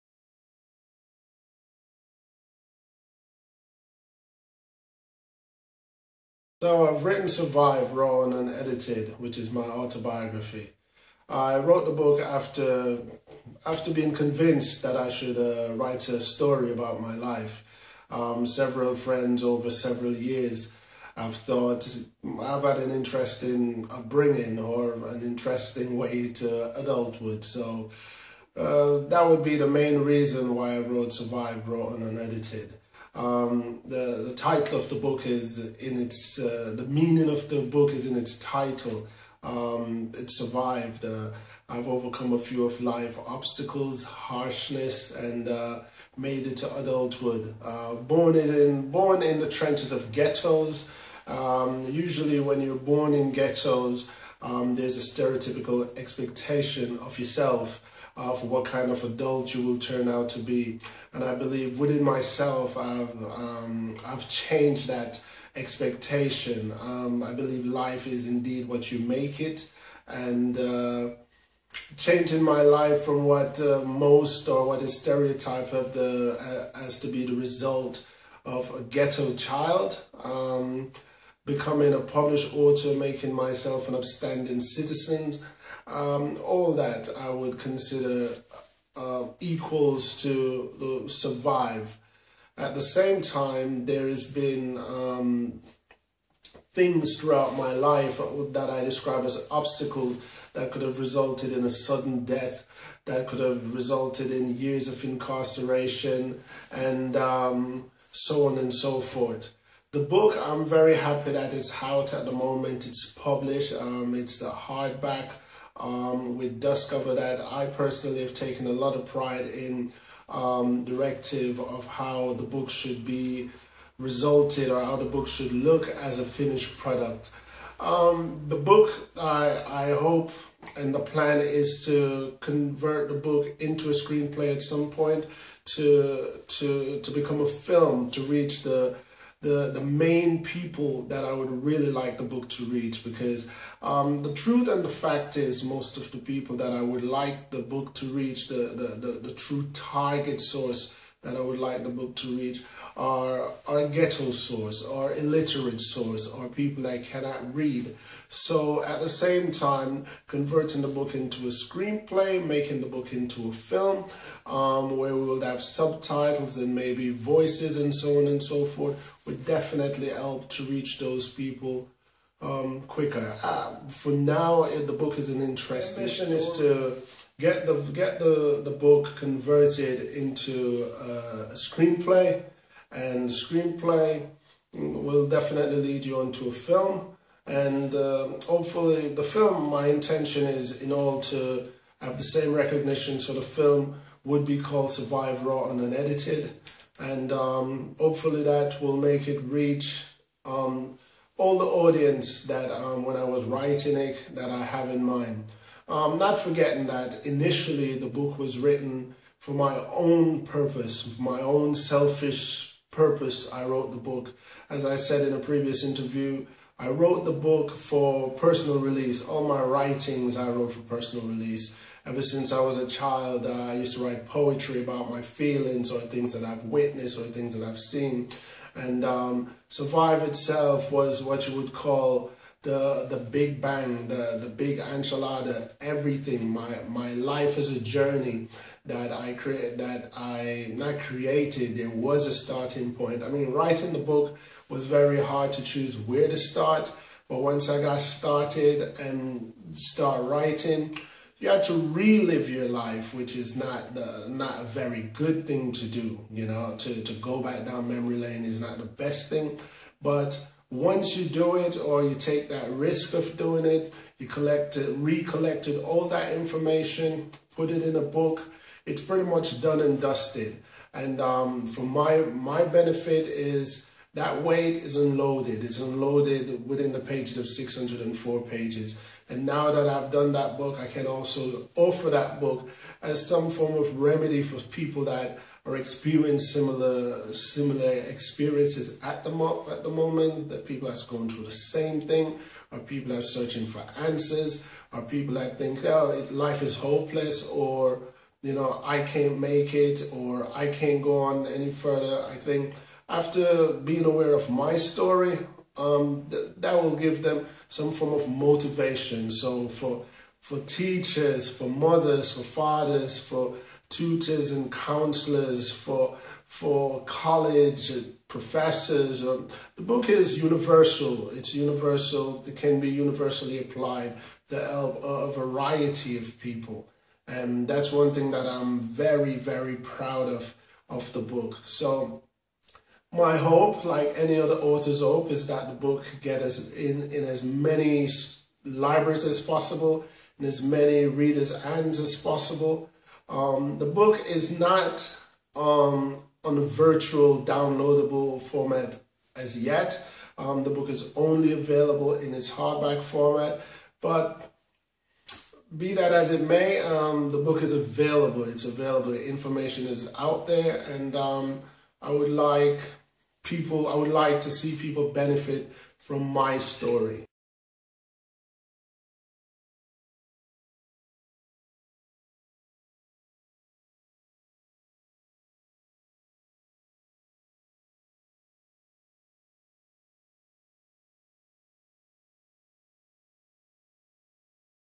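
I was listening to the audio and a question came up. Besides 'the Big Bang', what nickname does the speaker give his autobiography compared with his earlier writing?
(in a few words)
the Big Enchilada.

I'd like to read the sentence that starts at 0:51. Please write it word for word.
Um, usually, when you're born in ghettos, um, there's a stereotypical expectation of yourself.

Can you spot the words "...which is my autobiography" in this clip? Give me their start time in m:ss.
0:09.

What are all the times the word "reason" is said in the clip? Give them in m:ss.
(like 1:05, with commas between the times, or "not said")
0:30.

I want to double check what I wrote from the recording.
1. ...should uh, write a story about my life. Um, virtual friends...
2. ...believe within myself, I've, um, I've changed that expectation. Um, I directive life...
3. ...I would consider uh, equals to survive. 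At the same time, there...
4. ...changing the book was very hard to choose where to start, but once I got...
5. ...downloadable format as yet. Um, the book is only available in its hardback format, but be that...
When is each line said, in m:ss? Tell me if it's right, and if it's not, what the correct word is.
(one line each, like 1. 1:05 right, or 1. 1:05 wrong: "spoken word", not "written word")
1. 0:15 wrong: "several", not "virtual"
2. 1:01 wrong: "believe", not "directive"
3. 1:27 right
4. 4:03 wrong: "writing", not "changing"
5. 5:47 right.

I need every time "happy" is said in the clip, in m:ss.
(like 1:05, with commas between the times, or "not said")
1:50.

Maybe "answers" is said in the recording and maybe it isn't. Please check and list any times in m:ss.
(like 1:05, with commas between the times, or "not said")
4:54.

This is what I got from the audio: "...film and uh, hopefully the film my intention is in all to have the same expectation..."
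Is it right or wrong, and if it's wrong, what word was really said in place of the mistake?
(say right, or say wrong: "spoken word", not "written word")
wrong: "recognition", not "expectation".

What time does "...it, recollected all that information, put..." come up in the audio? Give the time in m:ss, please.
4:24.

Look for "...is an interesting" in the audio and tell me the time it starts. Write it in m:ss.
2:55.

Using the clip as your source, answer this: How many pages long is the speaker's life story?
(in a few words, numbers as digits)
604.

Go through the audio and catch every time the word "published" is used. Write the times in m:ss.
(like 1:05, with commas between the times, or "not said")
1:22, 1:53.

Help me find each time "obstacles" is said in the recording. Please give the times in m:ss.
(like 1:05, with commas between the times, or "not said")
0:43, 1:39.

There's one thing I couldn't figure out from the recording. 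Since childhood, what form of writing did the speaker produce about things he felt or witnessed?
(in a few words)
poetry.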